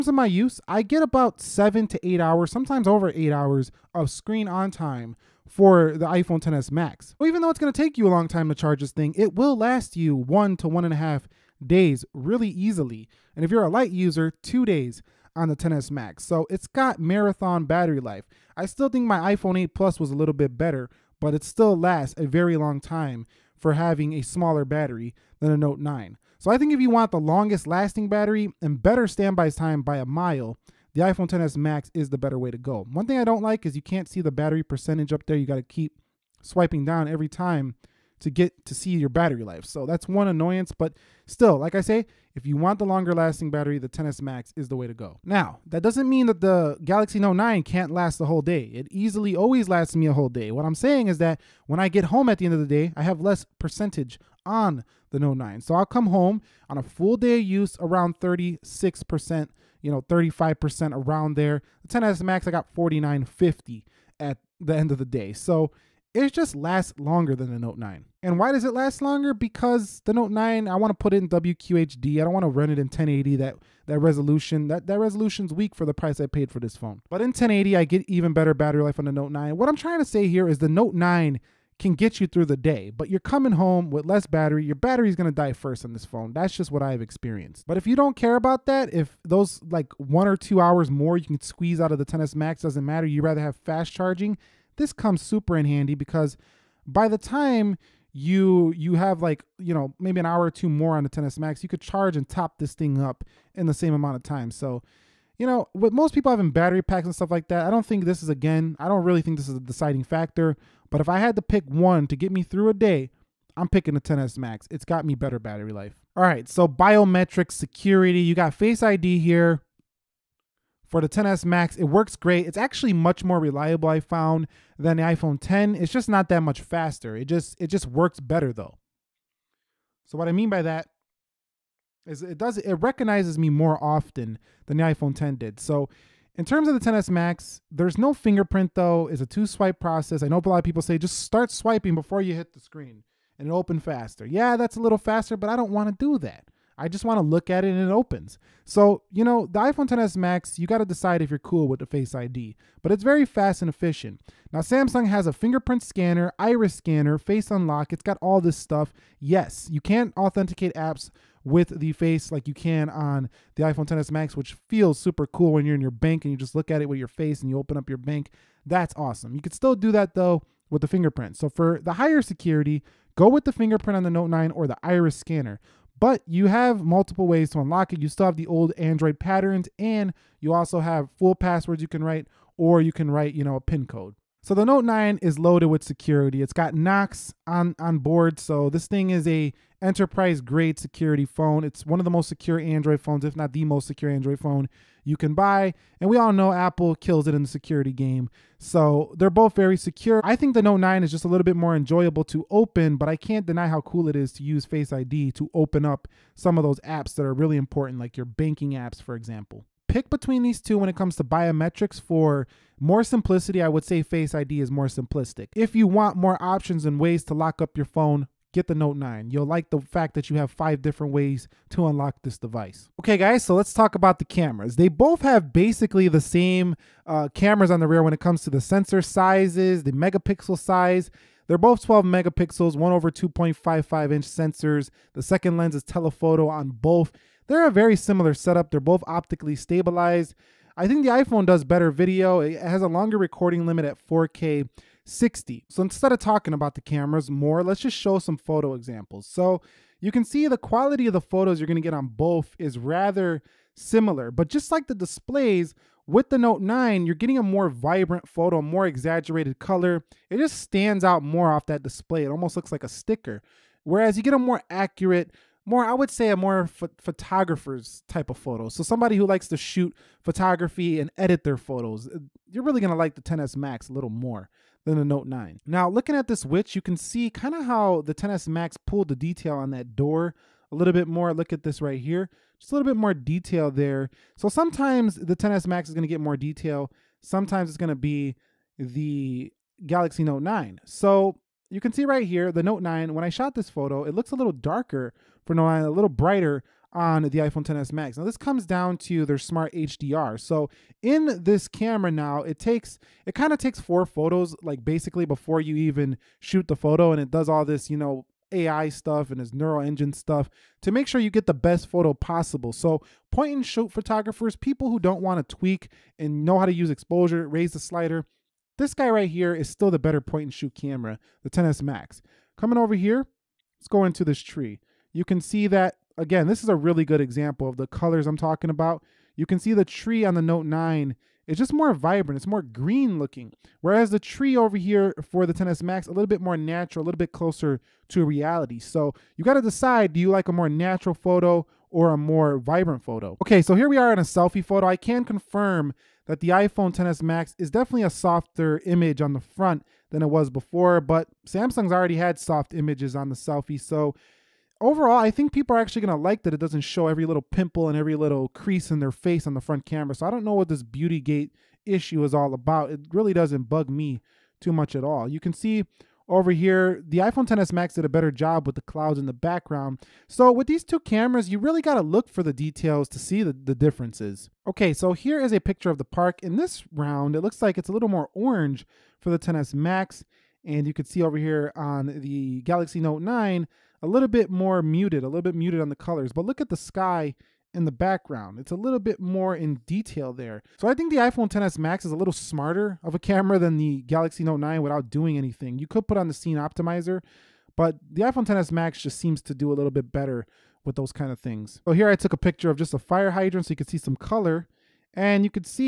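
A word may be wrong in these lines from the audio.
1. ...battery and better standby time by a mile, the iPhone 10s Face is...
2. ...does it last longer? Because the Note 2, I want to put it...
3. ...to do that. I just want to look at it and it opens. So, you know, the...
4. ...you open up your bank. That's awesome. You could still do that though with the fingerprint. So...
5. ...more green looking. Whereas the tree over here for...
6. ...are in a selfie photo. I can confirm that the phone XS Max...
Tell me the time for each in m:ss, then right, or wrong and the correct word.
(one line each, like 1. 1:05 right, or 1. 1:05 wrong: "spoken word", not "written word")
1. 0:28 wrong: "Max", not "Face"
2. 1:08 wrong: "9", not "2"
3. 2:25 right
4. 2:47 right
5. 5:32 right
6. 5:43 wrong: "iPhone", not "phone".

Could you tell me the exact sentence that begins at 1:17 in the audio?
But in 1080, I get even better battery life on the Note 9.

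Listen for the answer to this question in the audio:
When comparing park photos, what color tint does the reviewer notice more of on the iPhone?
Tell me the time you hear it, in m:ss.
6:18.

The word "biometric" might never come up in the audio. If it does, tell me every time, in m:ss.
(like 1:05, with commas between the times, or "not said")
1:56, 3:31.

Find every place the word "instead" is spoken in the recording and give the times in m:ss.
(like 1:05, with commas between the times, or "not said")
4:05.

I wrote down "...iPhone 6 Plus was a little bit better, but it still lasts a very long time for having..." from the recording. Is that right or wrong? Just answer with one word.
wrong.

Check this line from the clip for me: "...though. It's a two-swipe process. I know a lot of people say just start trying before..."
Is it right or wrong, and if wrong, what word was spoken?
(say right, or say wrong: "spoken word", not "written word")
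wrong: "swiping", not "trying".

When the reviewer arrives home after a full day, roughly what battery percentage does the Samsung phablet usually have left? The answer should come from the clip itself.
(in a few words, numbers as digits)
36%.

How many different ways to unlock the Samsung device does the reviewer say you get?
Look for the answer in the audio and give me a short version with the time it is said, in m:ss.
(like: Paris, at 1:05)
5, at 3:40.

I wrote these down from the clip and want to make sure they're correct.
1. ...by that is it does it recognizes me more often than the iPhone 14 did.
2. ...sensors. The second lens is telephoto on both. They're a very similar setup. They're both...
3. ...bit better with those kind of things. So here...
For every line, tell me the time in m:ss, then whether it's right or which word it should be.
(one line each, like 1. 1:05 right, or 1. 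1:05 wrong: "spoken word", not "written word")
1. 2:10 wrong: "10", not "14"
2. 3:54 right
3. 6:39 right.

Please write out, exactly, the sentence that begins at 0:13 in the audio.
And if you're a light user, two days on the 10s Max.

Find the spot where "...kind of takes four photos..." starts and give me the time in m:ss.
5:03.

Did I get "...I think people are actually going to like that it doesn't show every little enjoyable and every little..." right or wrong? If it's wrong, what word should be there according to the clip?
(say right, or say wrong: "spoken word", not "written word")
wrong: "pimple", not "enjoyable".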